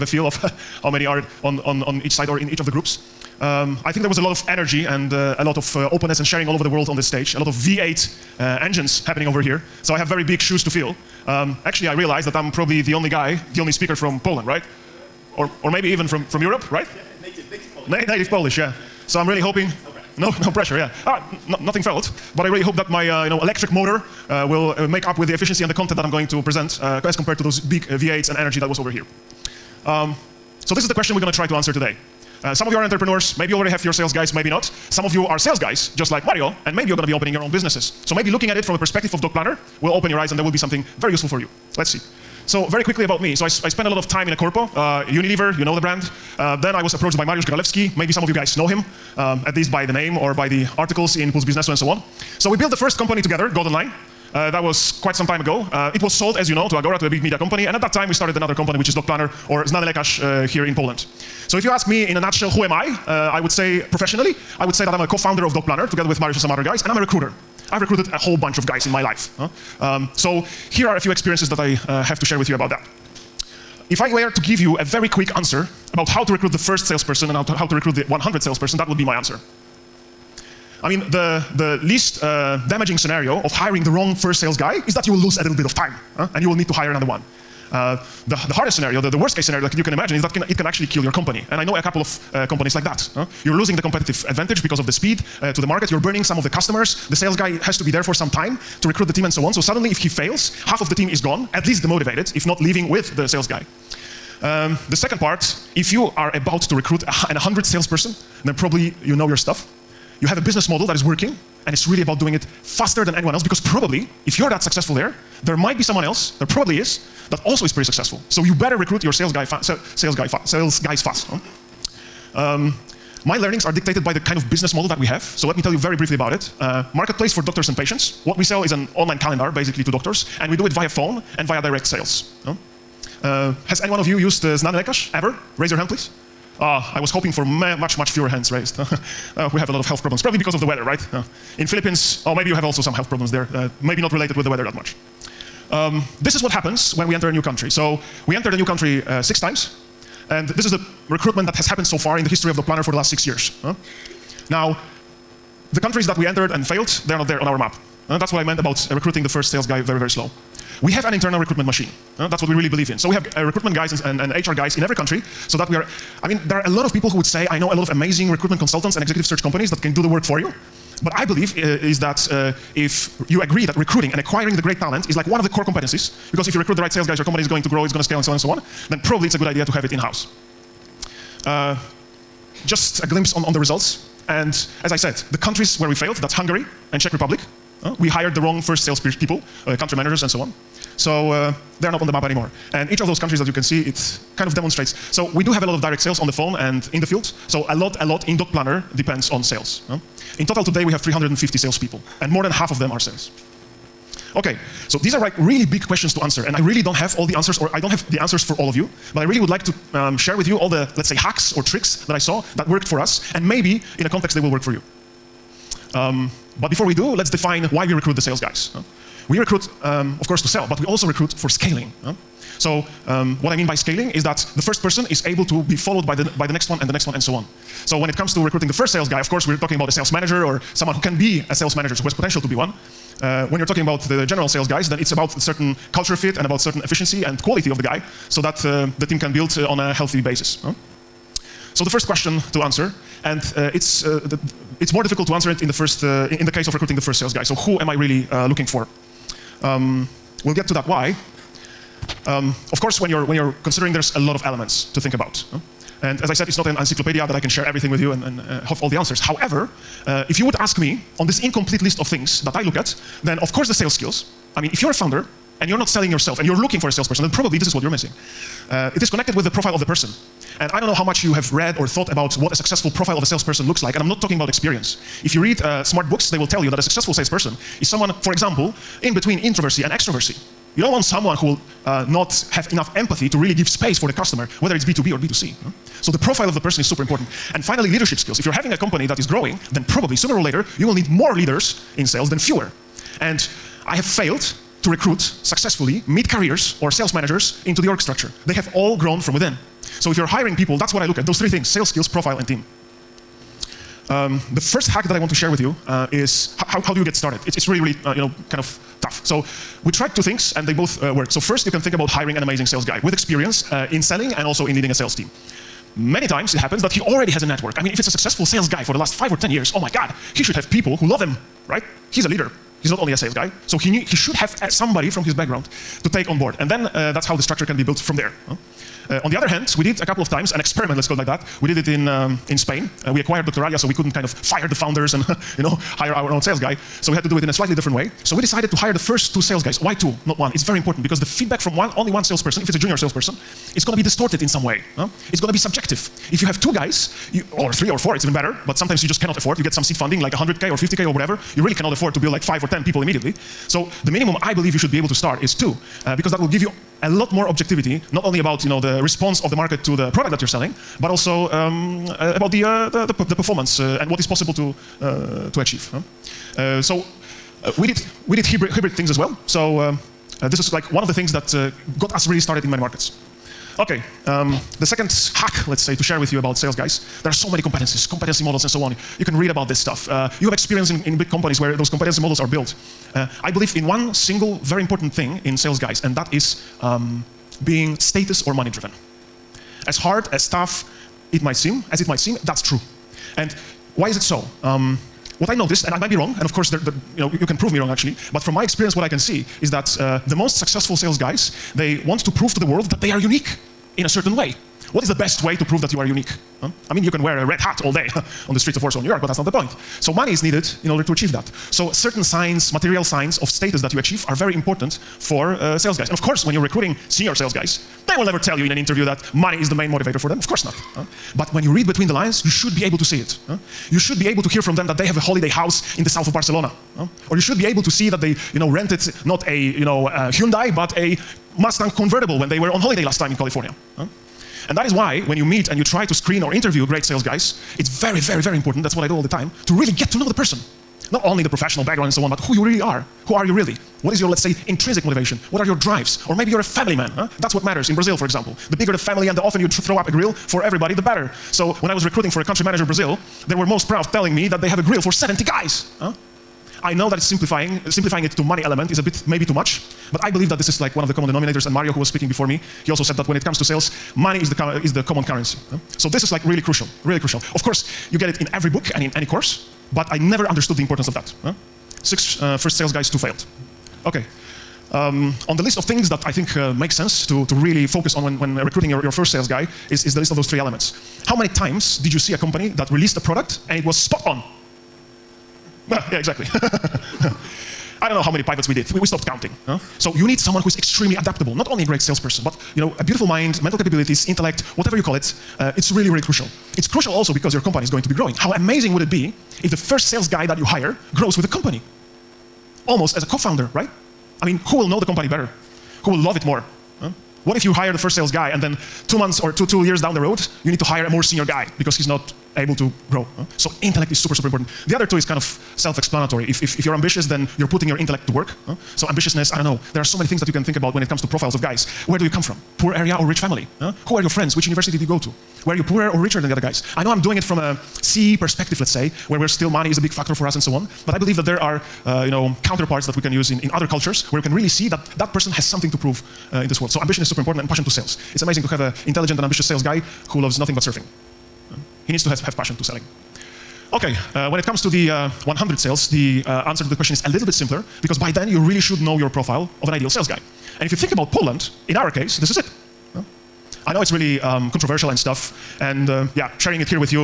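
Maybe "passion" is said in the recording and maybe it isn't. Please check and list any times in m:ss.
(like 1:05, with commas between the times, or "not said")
8:57, 9:02.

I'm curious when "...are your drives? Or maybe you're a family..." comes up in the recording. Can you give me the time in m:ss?
7:25.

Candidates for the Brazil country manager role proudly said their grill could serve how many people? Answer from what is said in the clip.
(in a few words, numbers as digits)
70.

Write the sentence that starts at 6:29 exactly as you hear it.
As hard, as tough it might seem, as it might seem, that's true.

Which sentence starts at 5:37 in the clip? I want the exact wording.
So we had to do it in a slightly different way.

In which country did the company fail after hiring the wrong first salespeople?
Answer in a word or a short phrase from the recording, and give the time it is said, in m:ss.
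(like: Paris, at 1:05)
Hungary, at 3:06.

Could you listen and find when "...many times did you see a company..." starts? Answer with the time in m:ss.
8:01.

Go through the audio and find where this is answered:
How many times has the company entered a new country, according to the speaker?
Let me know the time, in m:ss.
2:29.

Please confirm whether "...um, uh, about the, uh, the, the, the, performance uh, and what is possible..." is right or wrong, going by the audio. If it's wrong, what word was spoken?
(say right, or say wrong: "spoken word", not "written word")
right.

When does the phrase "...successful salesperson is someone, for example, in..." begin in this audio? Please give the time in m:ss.
4:36.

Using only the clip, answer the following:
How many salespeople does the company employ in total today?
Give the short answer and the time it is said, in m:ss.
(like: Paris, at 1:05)
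350, at 3:20.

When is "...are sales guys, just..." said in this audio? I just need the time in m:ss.
0:35.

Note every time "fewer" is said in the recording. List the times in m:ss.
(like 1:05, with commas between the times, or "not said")
2:18, 4:52.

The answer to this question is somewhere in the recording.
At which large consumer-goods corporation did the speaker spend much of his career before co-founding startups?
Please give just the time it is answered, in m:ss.
0:45.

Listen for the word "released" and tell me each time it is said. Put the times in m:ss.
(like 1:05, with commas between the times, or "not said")
8:02.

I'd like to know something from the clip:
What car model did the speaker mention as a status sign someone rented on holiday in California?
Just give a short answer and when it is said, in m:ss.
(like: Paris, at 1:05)
Mustang convertible, at 7:11.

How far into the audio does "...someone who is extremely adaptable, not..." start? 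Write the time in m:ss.
8:10.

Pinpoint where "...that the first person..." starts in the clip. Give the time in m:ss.
3:44.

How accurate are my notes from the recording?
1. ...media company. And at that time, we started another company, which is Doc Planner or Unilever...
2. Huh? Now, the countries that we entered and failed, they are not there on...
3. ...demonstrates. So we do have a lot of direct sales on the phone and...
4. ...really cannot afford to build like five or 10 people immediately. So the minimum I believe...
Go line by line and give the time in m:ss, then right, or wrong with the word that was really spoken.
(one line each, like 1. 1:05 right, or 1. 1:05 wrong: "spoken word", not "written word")
1. 0:57 wrong: "Znane", not "Unilever"
2. 2:33 right
3. 3:14 right
4. 5:51 right.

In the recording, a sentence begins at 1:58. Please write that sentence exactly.
So you better recruit your sales guy, sales guy, sales guys fast.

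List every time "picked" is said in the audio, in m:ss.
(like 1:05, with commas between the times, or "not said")
not said.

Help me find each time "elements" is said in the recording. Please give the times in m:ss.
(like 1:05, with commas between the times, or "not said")
4:14, 7:38, 8:00.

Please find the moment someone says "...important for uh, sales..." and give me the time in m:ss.
6:54.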